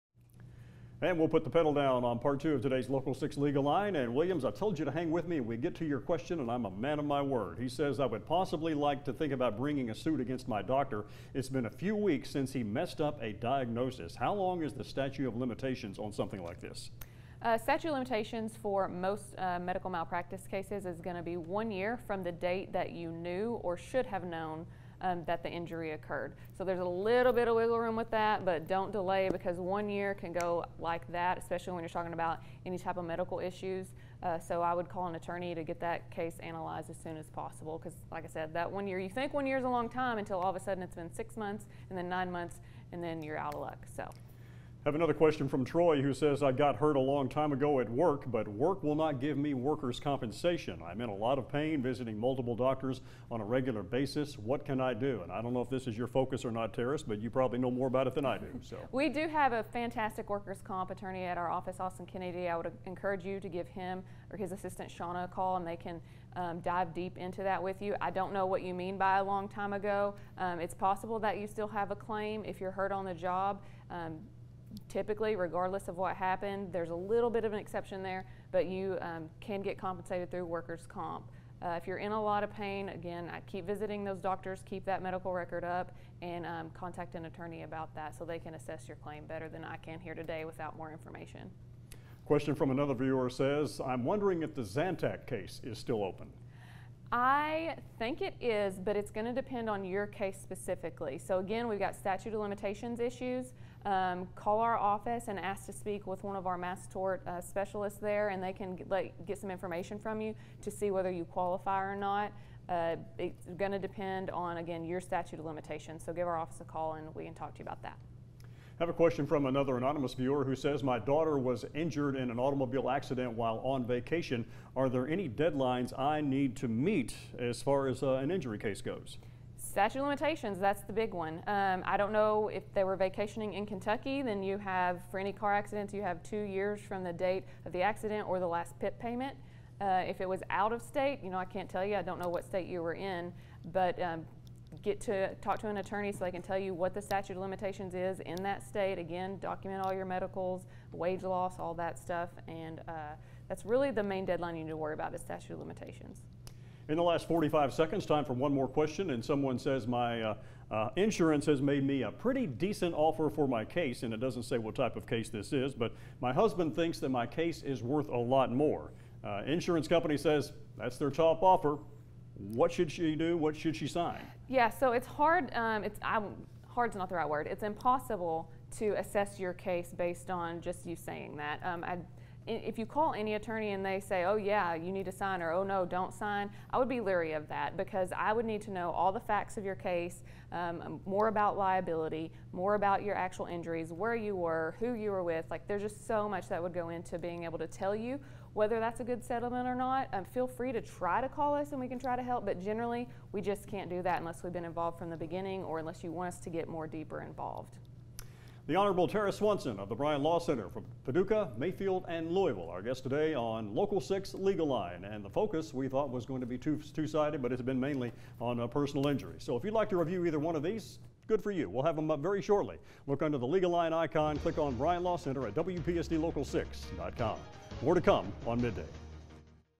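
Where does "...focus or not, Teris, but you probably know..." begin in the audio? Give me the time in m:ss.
0:56.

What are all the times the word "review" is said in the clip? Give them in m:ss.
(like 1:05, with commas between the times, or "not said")
3:39.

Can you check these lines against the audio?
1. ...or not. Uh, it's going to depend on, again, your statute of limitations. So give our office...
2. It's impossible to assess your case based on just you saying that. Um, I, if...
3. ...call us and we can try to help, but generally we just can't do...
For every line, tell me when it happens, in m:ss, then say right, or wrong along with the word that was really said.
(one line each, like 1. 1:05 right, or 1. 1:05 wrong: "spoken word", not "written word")
1. 1:51 right
2. 2:57 right
3. 3:21 right.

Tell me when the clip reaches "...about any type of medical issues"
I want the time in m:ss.
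0:32.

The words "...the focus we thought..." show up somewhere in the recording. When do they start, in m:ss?
3:35.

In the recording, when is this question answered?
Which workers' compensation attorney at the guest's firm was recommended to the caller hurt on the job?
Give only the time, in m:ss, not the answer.
1:01.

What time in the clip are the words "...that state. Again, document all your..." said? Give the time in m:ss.
2:28.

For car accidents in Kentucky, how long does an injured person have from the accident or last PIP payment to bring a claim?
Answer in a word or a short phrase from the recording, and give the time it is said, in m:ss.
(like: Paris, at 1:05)
2 years, at 2:16.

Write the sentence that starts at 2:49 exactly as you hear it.
Uh, insurance company says that's their top offer.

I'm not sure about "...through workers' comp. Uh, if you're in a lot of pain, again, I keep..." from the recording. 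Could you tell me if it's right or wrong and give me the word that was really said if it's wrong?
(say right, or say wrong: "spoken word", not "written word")
right.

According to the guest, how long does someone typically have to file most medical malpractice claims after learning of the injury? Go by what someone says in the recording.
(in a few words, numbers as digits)
1 year.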